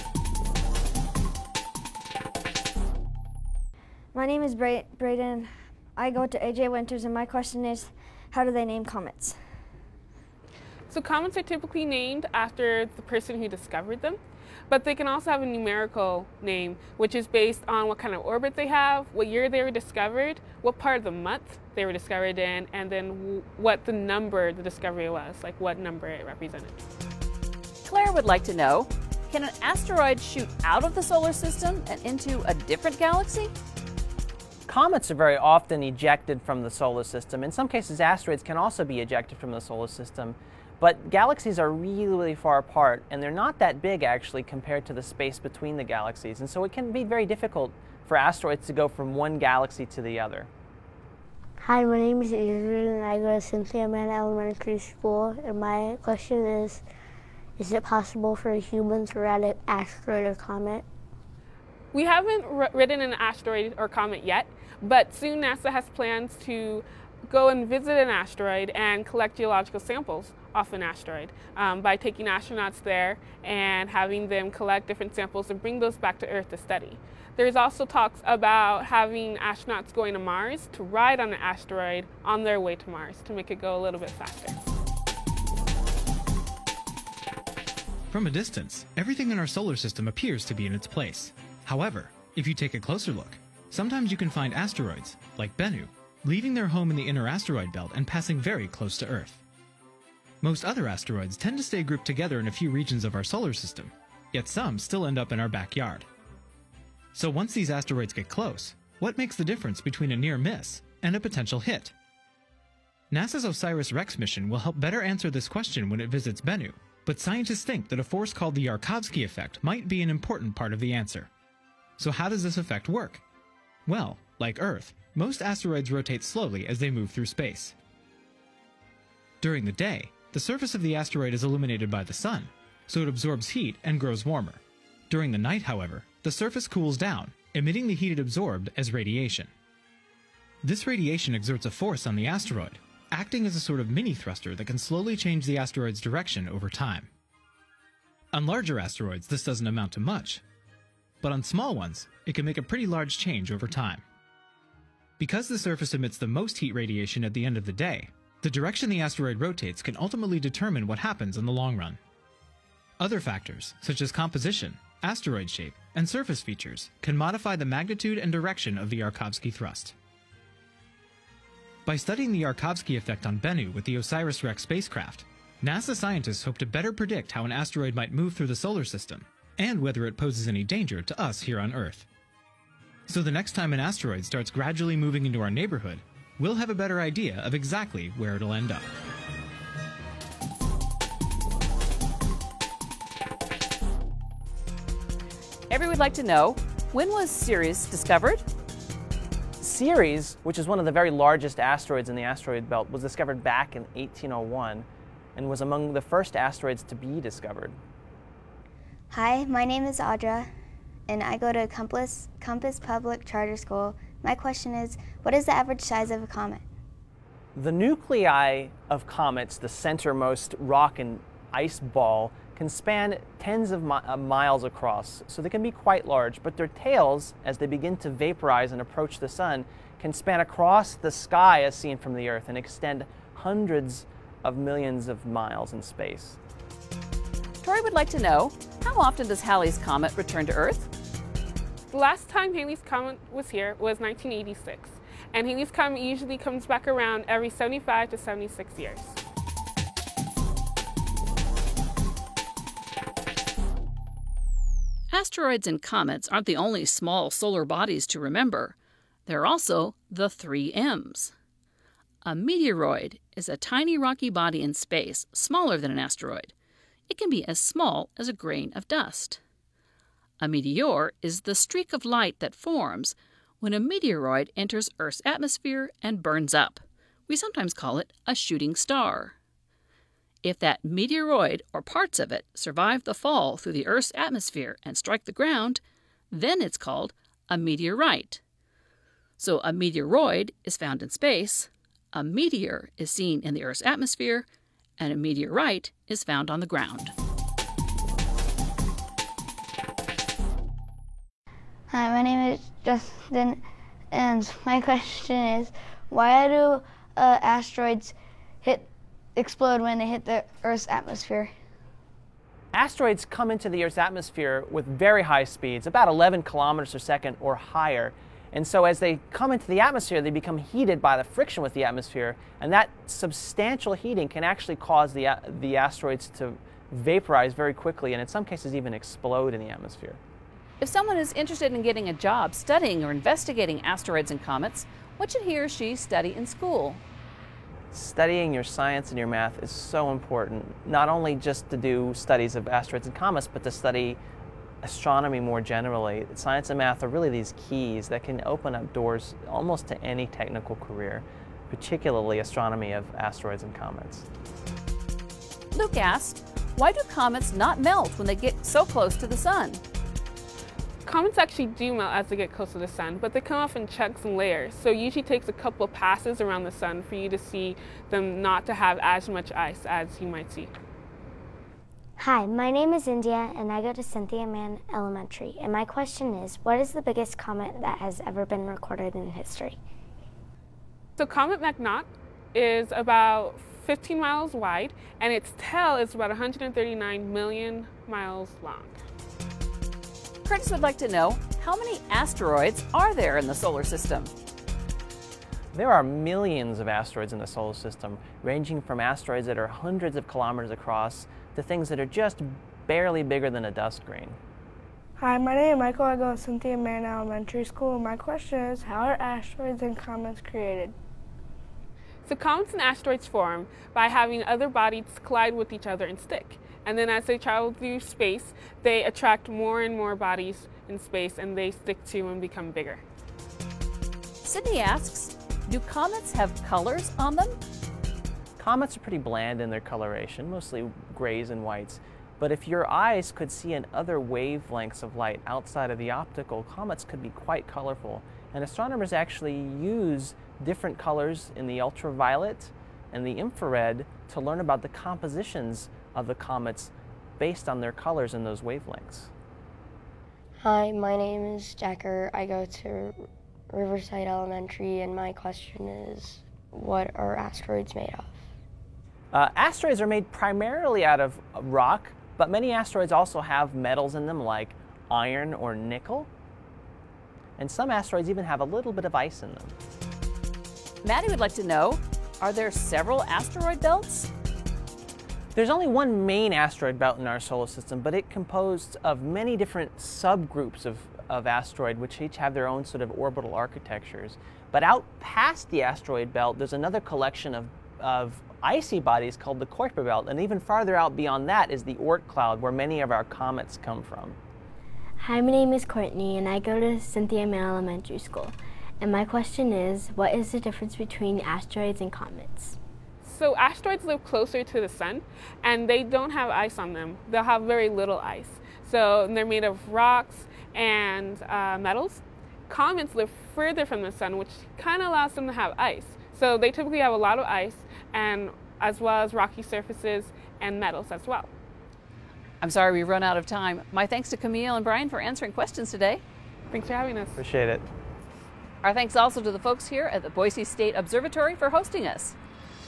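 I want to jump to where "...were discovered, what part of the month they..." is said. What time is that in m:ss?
0:19.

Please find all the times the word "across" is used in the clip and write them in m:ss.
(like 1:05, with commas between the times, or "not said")
3:44, 3:50, 6:40.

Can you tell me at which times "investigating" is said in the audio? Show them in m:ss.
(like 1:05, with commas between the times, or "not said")
5:33.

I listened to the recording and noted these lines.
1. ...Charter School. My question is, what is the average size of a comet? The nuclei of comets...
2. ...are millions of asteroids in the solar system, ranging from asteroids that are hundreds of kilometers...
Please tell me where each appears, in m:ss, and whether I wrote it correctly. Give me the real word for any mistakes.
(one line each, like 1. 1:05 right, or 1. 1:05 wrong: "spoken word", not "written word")
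1. 3:33 right
2. 6:35 right.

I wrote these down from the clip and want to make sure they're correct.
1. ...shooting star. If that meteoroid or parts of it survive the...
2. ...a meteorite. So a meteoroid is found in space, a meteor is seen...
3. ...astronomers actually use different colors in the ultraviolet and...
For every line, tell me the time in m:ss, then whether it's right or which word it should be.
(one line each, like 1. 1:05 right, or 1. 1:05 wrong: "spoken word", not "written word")
1. 4:38 right
2. 4:47 right
3. 7:18 right.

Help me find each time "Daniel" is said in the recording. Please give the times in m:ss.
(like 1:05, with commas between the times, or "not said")
not said.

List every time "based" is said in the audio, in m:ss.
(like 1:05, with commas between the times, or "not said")
0:17, 7:27.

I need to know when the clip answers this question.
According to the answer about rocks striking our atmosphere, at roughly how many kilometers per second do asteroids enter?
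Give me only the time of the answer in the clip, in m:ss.
5:16.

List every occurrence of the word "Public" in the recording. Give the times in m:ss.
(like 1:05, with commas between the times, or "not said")
3:32.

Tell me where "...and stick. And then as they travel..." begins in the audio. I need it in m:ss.
6:56.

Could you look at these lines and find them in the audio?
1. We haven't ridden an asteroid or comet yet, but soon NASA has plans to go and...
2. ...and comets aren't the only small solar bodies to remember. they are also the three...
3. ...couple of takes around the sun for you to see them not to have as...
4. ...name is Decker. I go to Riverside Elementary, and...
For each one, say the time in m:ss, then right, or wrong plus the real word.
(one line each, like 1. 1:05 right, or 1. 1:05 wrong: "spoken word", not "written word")
1. 1:01 right
2. 4:15 right
3. 6:05 wrong: "passes", not "takes"
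4. 7:31 right.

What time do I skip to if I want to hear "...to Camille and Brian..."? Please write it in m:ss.
8:44.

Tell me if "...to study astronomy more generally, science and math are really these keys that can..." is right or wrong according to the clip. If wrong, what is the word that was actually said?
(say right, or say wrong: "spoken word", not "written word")
right.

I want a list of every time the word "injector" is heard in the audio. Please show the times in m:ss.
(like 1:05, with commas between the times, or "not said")
not said.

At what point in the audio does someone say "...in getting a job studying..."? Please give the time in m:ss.
5:31.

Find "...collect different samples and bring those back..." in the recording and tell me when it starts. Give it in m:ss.
1:14.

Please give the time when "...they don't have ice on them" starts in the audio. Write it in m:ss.
8:25.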